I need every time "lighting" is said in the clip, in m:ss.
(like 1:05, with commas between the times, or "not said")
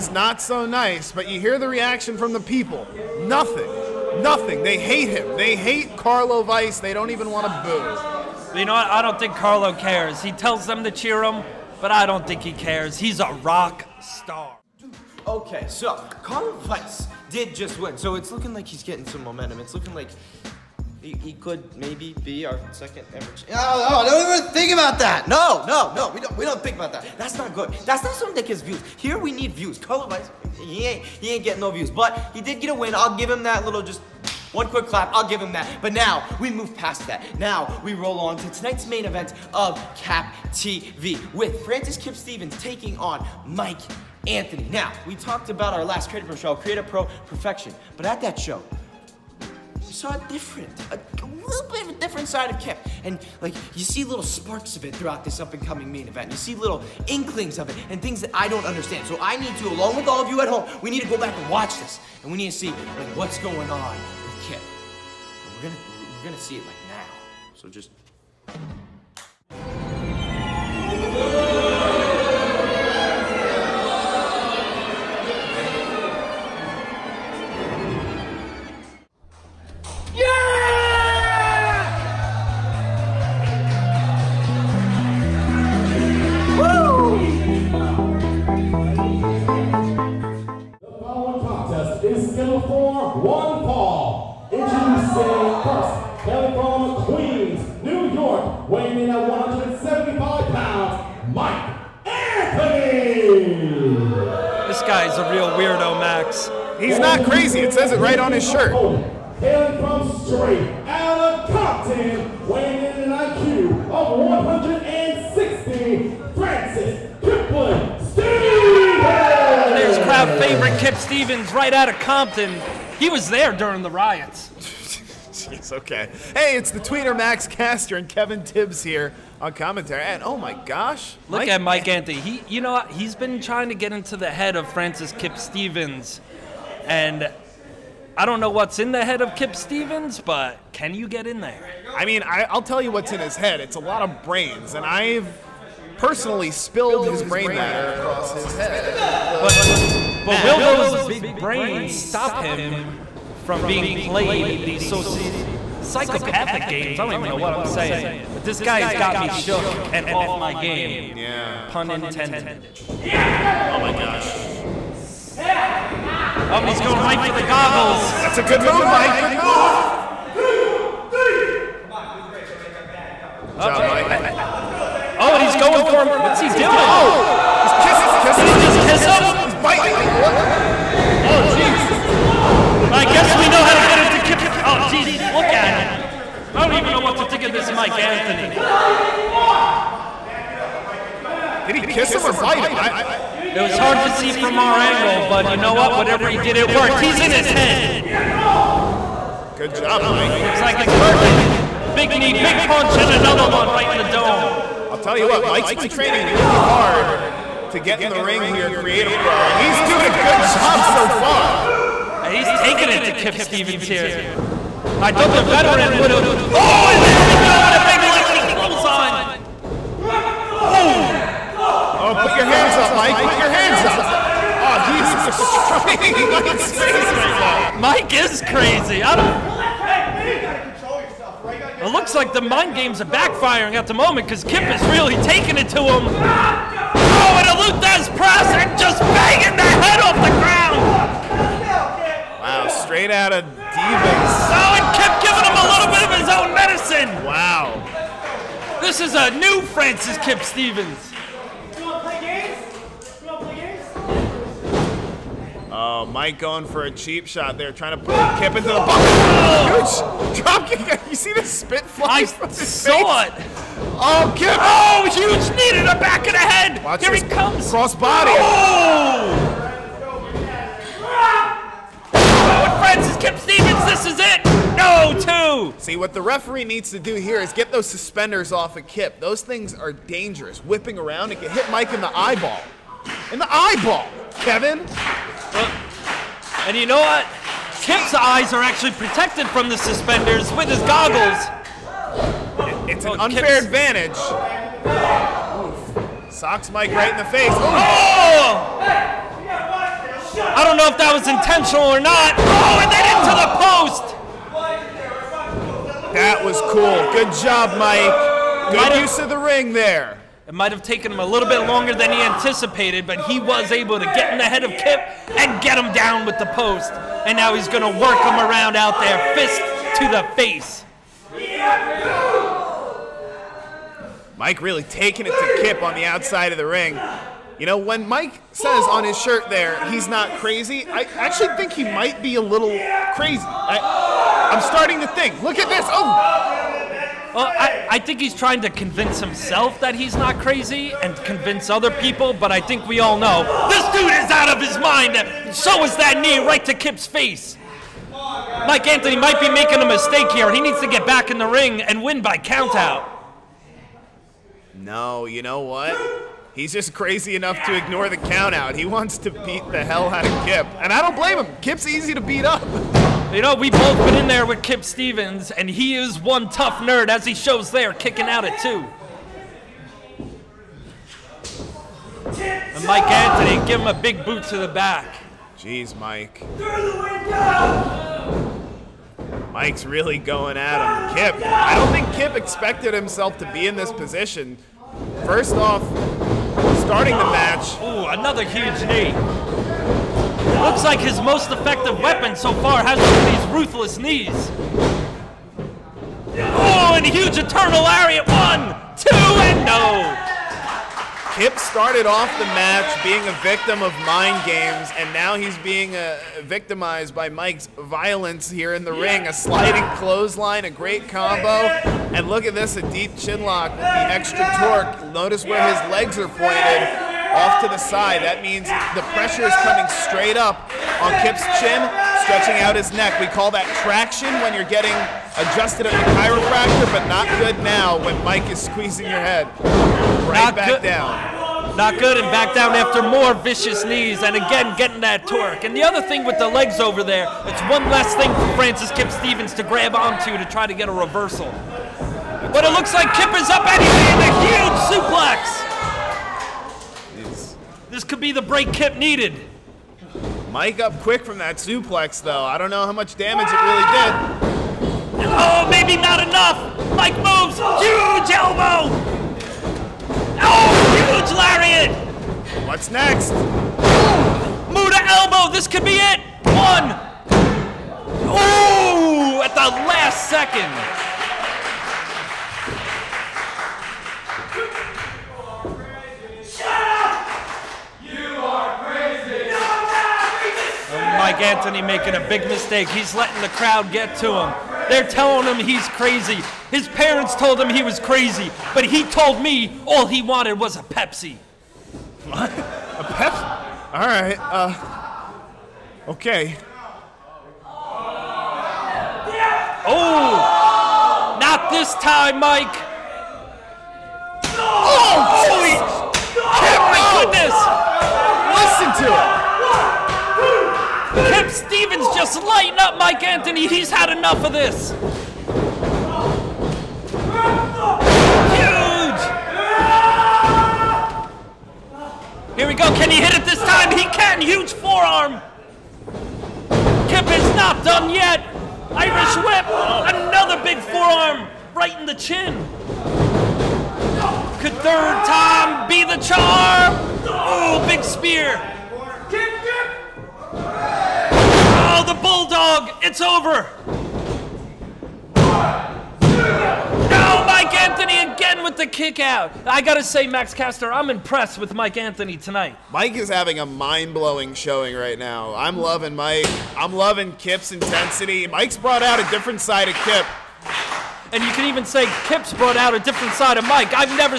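8:32.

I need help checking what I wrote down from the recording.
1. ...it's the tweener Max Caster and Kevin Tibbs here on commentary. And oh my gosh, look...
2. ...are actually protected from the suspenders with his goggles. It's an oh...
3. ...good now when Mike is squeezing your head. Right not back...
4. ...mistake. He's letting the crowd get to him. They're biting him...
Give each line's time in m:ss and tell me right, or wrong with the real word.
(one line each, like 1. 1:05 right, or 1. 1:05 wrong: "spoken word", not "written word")
1. 2:06 right
2. 4:48 right
3. 7:07 right
4. 8:02 wrong: "telling", not "biting".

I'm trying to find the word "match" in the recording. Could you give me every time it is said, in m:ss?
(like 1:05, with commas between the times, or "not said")
6:27, 6:42.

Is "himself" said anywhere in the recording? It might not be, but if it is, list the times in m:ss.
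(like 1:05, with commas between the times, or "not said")
5:39, 6:22.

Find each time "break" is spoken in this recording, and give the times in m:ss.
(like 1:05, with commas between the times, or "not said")
7:28.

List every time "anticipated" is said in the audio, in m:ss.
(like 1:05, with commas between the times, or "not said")
5:12.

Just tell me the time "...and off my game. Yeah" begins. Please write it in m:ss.
2:39.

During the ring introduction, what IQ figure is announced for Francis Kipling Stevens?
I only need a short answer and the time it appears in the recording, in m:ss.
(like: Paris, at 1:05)
160, at 1:54.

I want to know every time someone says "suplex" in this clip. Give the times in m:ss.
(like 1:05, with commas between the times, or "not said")
7:24, 7:31.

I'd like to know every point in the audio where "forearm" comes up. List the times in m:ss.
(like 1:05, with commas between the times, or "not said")
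8:44, 8:50.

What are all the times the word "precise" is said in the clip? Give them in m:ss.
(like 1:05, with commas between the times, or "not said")
not said.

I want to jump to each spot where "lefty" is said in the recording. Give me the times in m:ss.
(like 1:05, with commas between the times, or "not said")
3:40.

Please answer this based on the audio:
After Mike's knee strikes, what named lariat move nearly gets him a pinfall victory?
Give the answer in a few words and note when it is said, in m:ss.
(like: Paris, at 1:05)
Eternal Lariat, at 6:37.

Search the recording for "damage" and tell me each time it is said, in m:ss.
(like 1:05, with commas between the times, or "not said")
7:33.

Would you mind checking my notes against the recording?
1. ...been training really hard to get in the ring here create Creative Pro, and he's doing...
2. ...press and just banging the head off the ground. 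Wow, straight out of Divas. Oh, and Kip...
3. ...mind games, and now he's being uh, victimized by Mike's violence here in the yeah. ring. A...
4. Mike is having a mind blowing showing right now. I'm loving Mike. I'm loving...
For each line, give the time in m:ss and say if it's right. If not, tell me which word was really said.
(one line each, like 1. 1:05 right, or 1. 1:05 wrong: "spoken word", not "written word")
1. 3:25 right
2. 3:58 right
3. 6:44 right
4. 9:12 right.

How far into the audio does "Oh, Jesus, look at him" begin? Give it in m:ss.
3:04.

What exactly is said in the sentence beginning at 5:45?
So is that knee right to Kip's face.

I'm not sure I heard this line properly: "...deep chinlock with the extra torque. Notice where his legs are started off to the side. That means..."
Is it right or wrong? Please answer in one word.
wrong.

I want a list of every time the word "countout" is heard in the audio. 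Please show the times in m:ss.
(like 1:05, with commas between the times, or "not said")
5:52, 5:58.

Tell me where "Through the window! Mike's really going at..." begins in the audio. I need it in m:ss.
6:16.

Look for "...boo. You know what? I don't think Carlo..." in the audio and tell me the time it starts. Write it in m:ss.
0:08.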